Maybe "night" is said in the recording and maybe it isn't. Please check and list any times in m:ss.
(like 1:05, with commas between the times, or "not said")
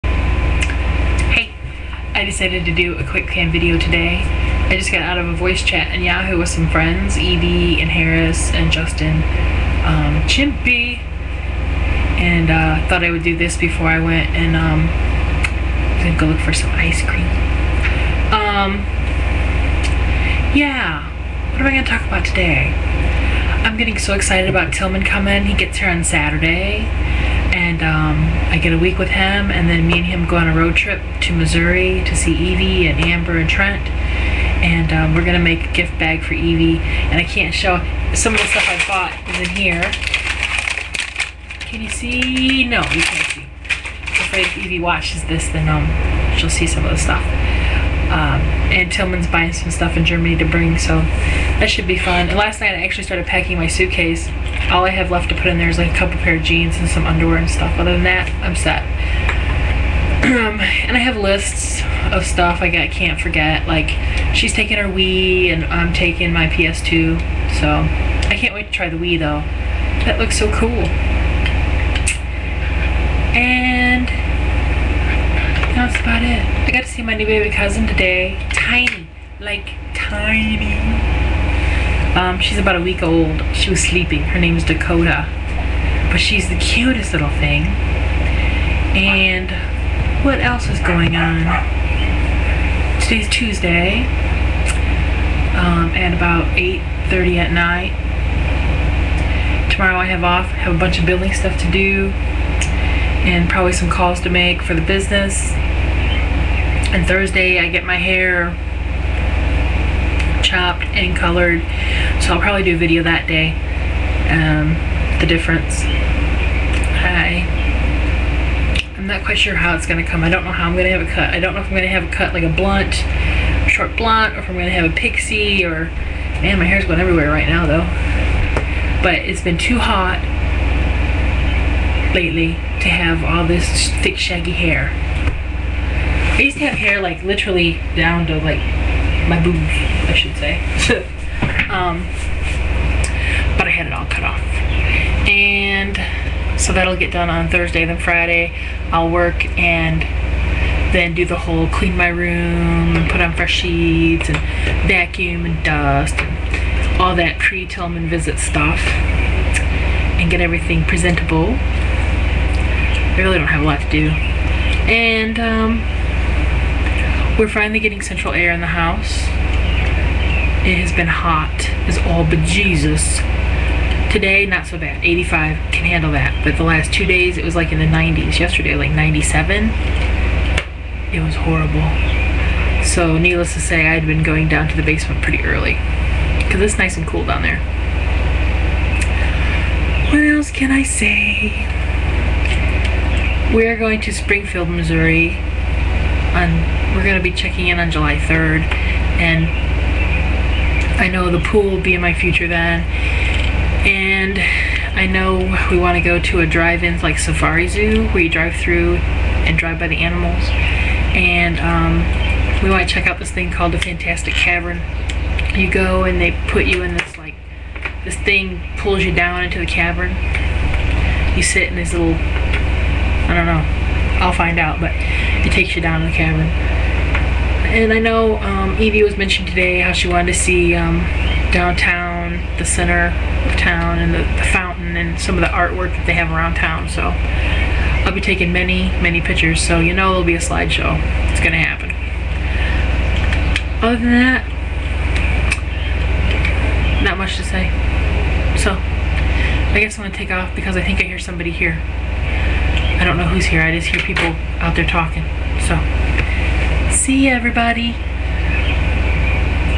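0:52, 1:37.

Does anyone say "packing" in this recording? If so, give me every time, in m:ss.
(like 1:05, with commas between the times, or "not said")
0:53.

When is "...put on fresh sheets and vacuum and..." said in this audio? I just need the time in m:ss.
2:33.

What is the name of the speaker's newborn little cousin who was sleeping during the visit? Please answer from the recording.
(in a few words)
Dakota.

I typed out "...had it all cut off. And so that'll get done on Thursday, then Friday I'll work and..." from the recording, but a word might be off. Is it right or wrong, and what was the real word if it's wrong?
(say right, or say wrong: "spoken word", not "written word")
right.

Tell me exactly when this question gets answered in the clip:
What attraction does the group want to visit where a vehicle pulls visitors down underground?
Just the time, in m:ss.
3:33.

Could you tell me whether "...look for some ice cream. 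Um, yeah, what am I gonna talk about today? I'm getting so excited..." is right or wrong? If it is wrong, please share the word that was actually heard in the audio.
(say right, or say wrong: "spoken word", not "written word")
right.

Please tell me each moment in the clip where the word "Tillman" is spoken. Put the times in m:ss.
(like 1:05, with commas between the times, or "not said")
0:24, 0:48, 2:37.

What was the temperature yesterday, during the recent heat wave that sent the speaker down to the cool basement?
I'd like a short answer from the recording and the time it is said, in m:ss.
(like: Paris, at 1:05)
97, at 2:58.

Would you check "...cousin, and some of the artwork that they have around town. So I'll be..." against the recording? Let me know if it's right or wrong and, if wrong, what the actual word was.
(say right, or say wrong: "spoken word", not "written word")
wrong: "fountain", not "cousin".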